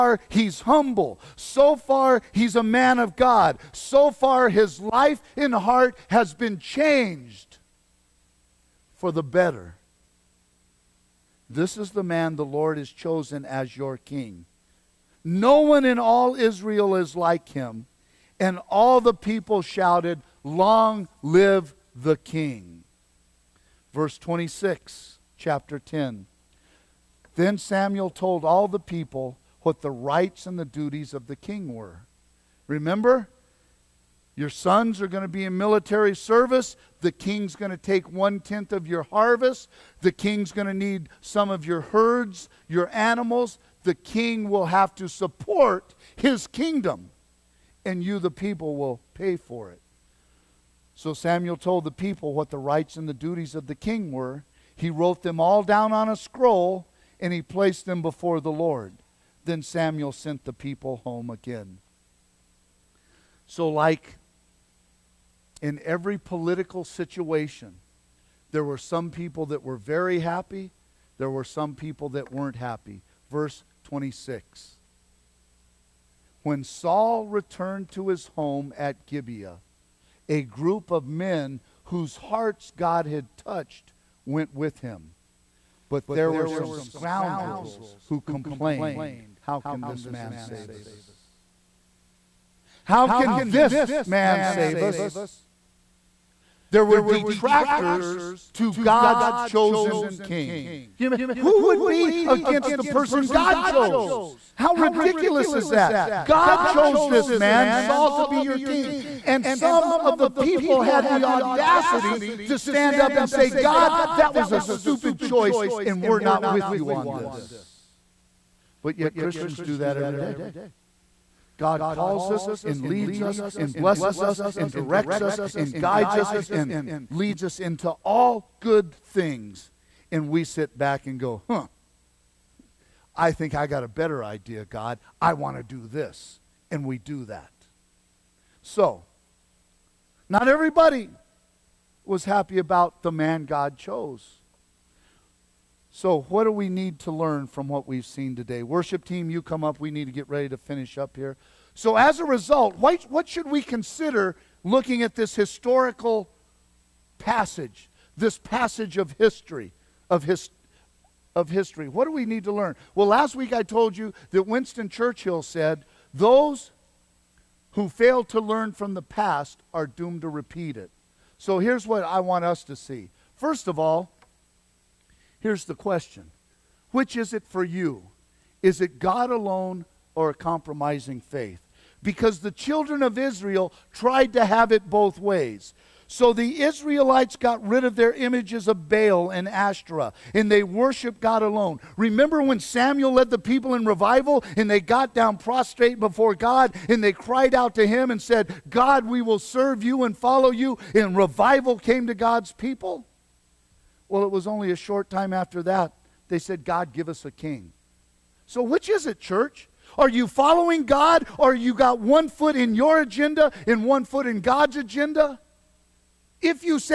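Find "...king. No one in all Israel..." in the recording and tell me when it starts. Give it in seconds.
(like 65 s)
13 s.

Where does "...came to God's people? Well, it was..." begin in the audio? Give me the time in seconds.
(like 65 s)
201 s.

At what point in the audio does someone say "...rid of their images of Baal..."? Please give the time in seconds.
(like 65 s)
187 s.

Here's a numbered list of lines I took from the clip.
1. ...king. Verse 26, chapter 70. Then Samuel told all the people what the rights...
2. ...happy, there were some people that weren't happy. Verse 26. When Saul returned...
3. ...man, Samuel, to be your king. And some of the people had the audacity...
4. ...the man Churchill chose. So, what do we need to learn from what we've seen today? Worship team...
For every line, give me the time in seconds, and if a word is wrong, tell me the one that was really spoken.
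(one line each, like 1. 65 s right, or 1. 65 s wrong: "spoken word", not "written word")
1. 22 s wrong: "10", not "70"
2. 70 s right
3. 107 s wrong: "Saul", not "Samuel"
4. 143 s wrong: "God", not "Churchill".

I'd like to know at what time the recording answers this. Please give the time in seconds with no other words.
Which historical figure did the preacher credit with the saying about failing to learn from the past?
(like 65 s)
164 s.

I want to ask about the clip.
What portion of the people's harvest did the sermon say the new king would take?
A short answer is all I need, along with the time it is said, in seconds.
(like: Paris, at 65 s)
One tenth, at 38 s.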